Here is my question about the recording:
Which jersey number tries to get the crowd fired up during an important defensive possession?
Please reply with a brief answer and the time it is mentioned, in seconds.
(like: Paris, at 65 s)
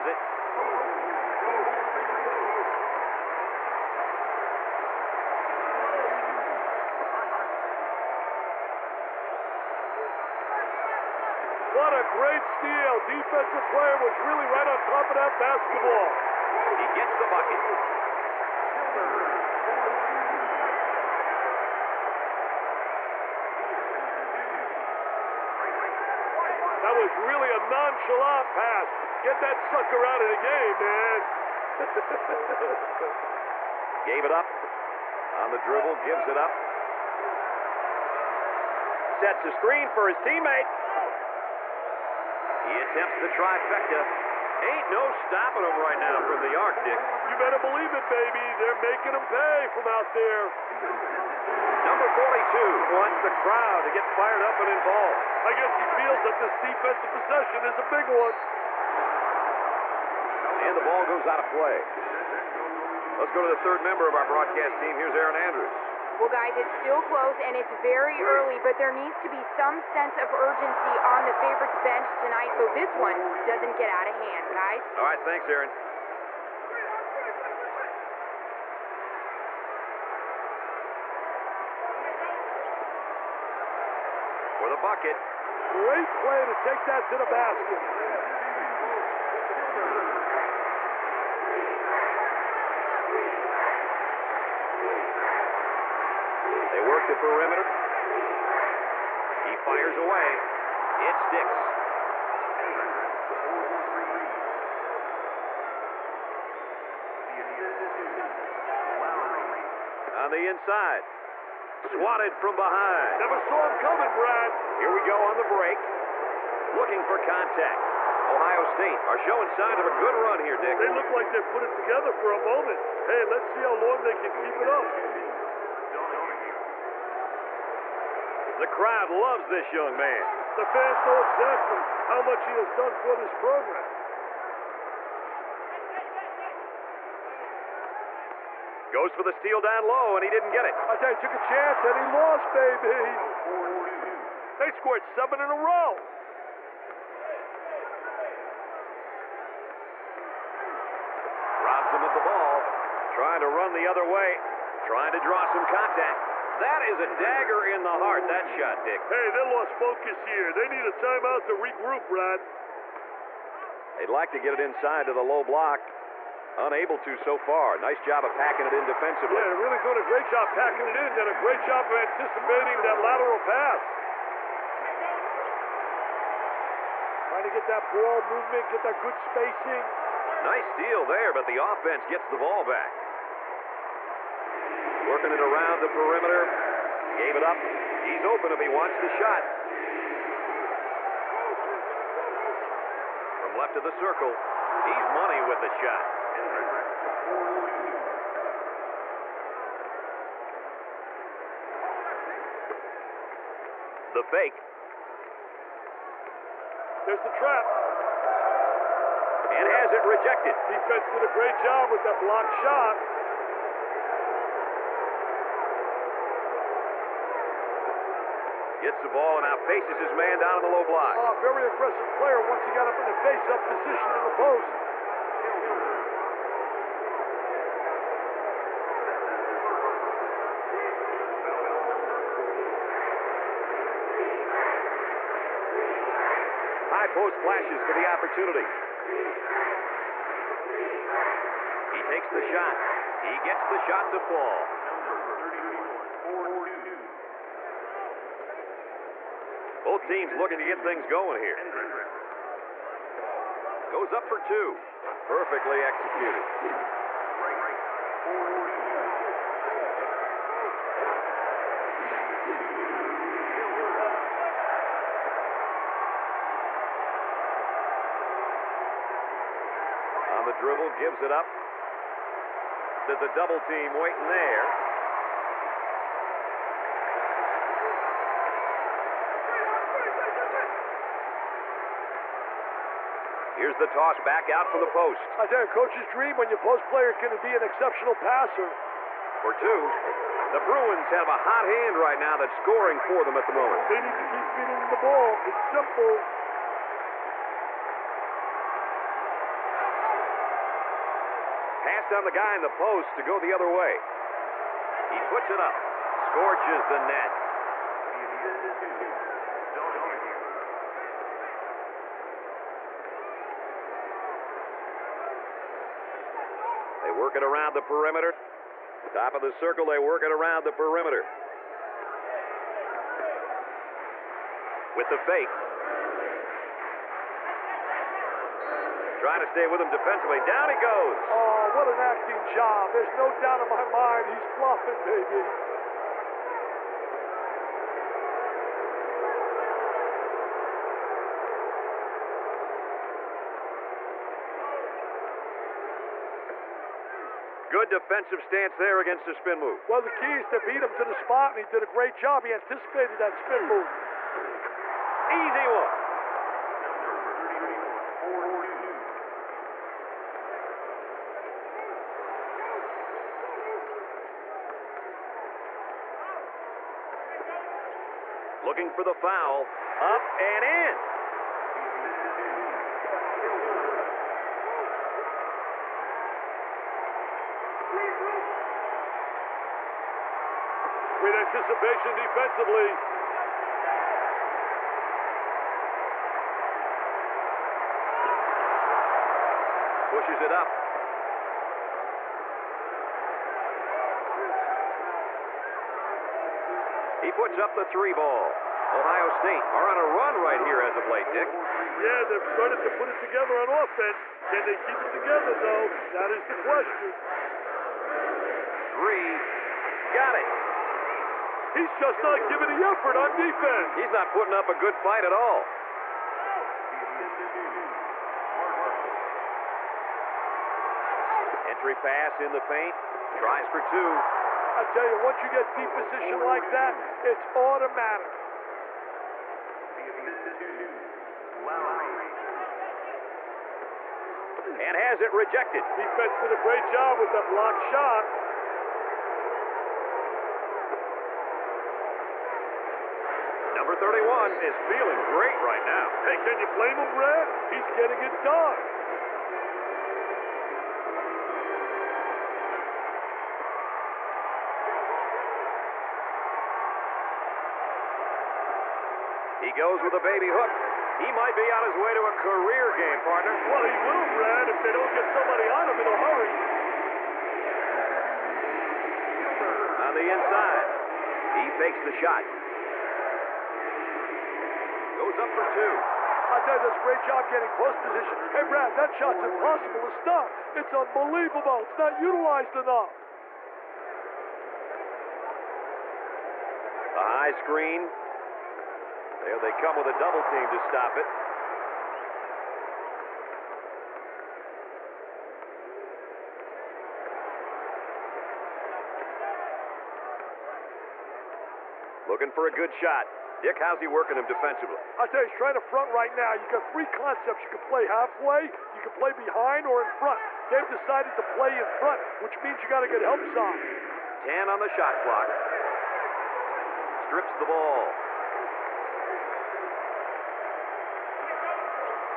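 42, at 51 s.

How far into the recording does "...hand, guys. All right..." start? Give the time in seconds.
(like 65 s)
74 s.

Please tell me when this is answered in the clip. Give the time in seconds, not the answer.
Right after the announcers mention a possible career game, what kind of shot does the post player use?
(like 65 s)
460 s.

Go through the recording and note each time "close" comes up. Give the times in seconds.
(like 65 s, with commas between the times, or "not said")
67 s.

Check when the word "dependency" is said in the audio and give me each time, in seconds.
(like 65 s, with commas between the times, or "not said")
not said.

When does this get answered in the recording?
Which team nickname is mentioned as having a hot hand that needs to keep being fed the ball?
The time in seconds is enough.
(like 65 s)
290 s.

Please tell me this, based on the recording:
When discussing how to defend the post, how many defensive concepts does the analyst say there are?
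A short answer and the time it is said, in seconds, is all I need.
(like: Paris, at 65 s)
3, at 506 s.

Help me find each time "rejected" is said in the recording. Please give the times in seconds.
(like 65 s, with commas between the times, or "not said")
210 s, 435 s.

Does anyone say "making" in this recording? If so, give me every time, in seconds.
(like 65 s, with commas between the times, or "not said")
48 s.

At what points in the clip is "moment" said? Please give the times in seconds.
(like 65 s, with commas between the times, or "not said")
122 s, 293 s.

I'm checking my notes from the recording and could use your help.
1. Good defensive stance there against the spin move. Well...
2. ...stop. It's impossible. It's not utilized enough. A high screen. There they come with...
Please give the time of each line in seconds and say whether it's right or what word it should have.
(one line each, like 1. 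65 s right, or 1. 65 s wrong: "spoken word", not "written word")
1. 347 s right
2. 480 s wrong: "unbelievable", not "impossible".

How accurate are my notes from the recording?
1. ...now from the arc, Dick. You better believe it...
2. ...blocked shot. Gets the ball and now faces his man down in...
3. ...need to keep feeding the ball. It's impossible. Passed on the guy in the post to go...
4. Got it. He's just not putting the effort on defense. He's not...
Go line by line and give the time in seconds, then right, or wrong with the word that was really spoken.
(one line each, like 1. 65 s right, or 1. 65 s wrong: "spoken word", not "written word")
1. 46 s right
2. 212 s right
3. 293 s wrong: "simple", not "impossible"
4. 410 s wrong: "giving", not "putting".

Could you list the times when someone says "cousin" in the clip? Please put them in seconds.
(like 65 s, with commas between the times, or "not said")
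not said.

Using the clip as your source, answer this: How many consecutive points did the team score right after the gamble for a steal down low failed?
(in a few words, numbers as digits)
7.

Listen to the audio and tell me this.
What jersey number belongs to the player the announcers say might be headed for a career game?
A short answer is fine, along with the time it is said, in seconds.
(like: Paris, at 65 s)
31, at 444 s.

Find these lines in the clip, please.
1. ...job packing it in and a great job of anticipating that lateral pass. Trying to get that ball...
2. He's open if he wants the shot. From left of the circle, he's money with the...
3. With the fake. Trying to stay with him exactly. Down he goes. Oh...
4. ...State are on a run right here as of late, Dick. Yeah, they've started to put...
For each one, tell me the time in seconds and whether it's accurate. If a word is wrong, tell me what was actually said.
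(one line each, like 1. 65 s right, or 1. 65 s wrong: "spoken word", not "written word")
1. 170 s right
2. 188 s right
3. 324 s wrong: "defensively", not "exactly"
4. 399 s right.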